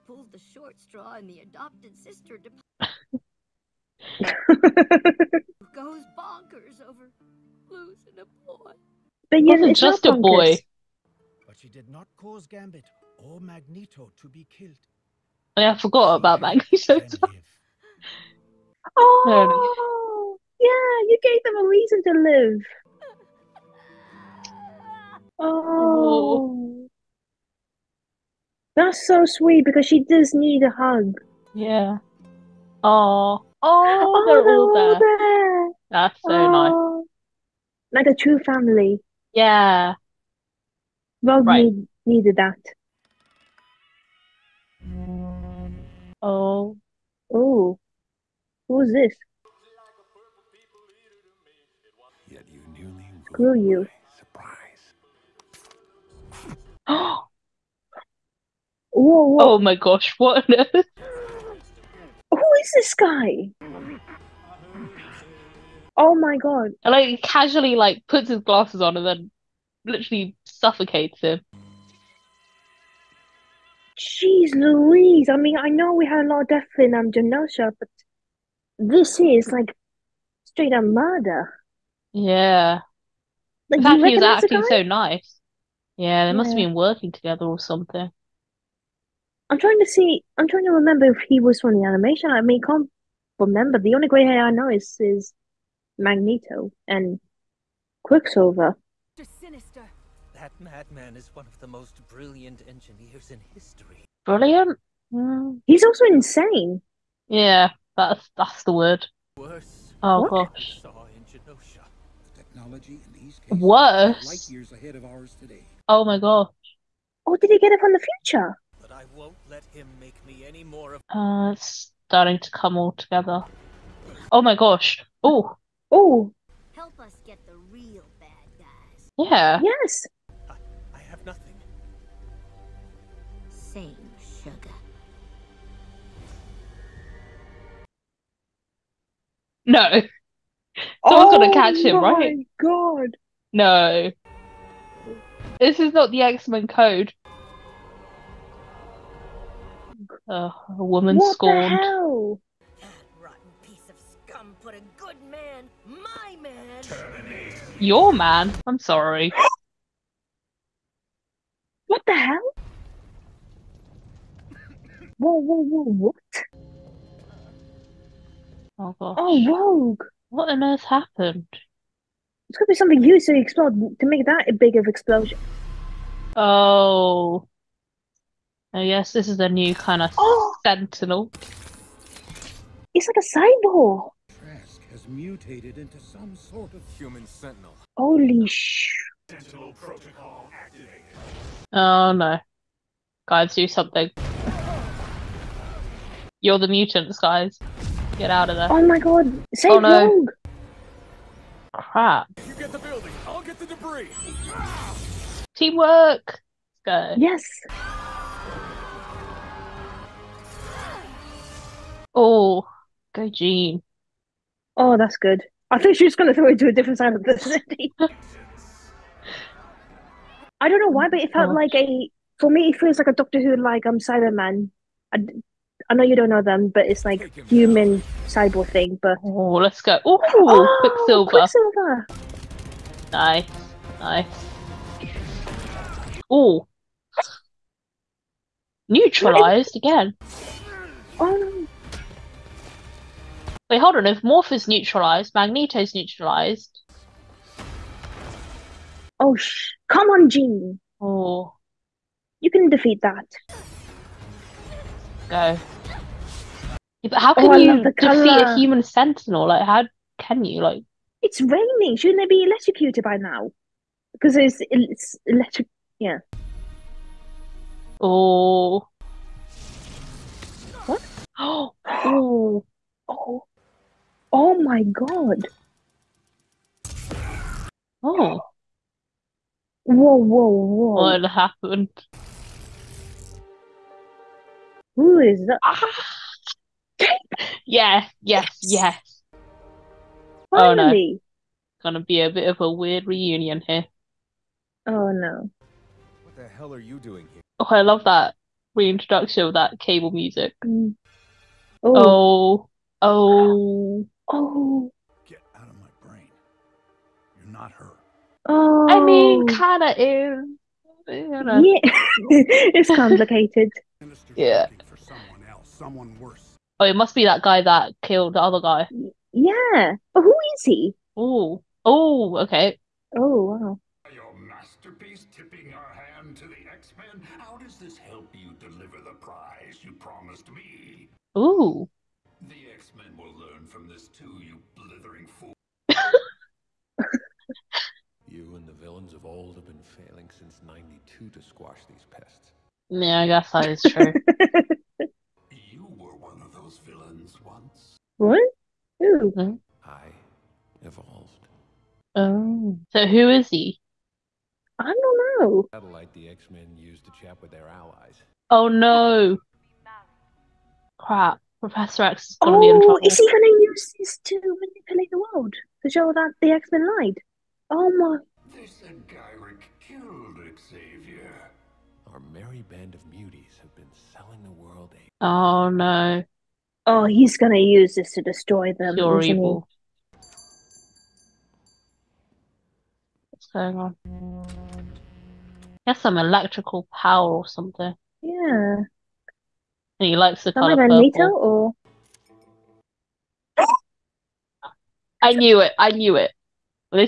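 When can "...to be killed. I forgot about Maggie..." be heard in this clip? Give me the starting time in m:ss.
0:14.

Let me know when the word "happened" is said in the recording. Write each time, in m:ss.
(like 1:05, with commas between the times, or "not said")
2:50, 4:41.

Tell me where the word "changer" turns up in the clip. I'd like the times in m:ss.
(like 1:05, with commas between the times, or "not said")
not said.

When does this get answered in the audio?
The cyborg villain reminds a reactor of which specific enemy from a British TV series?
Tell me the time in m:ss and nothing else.
3:43.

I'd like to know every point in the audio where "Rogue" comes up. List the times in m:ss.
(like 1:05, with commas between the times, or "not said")
0:41, 2:49.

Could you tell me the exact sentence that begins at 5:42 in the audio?
Yeah, I guess that is true.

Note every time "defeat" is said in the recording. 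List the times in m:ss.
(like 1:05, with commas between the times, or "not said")
4:12, 4:17.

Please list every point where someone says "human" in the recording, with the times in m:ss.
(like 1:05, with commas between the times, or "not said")
3:06, 3:47, 4:18.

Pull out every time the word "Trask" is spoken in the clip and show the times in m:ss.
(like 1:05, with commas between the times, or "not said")
3:04.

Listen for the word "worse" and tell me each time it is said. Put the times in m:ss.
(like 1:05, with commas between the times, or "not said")
1:49, 1:53, 5:16.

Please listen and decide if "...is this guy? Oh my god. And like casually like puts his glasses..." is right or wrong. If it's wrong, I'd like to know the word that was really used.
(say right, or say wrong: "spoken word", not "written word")
right.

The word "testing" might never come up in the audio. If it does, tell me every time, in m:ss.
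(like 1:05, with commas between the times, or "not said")
not said.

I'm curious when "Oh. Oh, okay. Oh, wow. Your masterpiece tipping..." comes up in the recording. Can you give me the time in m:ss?
5:21.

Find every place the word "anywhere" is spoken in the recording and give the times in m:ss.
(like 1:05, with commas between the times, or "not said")
not said.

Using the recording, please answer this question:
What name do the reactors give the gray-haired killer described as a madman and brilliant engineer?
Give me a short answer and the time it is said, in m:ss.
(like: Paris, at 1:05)
Sinister, at 1:39.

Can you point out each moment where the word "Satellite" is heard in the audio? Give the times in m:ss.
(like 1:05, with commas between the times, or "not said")
5:55.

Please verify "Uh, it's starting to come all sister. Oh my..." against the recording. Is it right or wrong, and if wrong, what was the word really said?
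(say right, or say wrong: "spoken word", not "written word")
wrong: "together", not "sister".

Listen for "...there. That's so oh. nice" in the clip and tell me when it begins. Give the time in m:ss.
0:34.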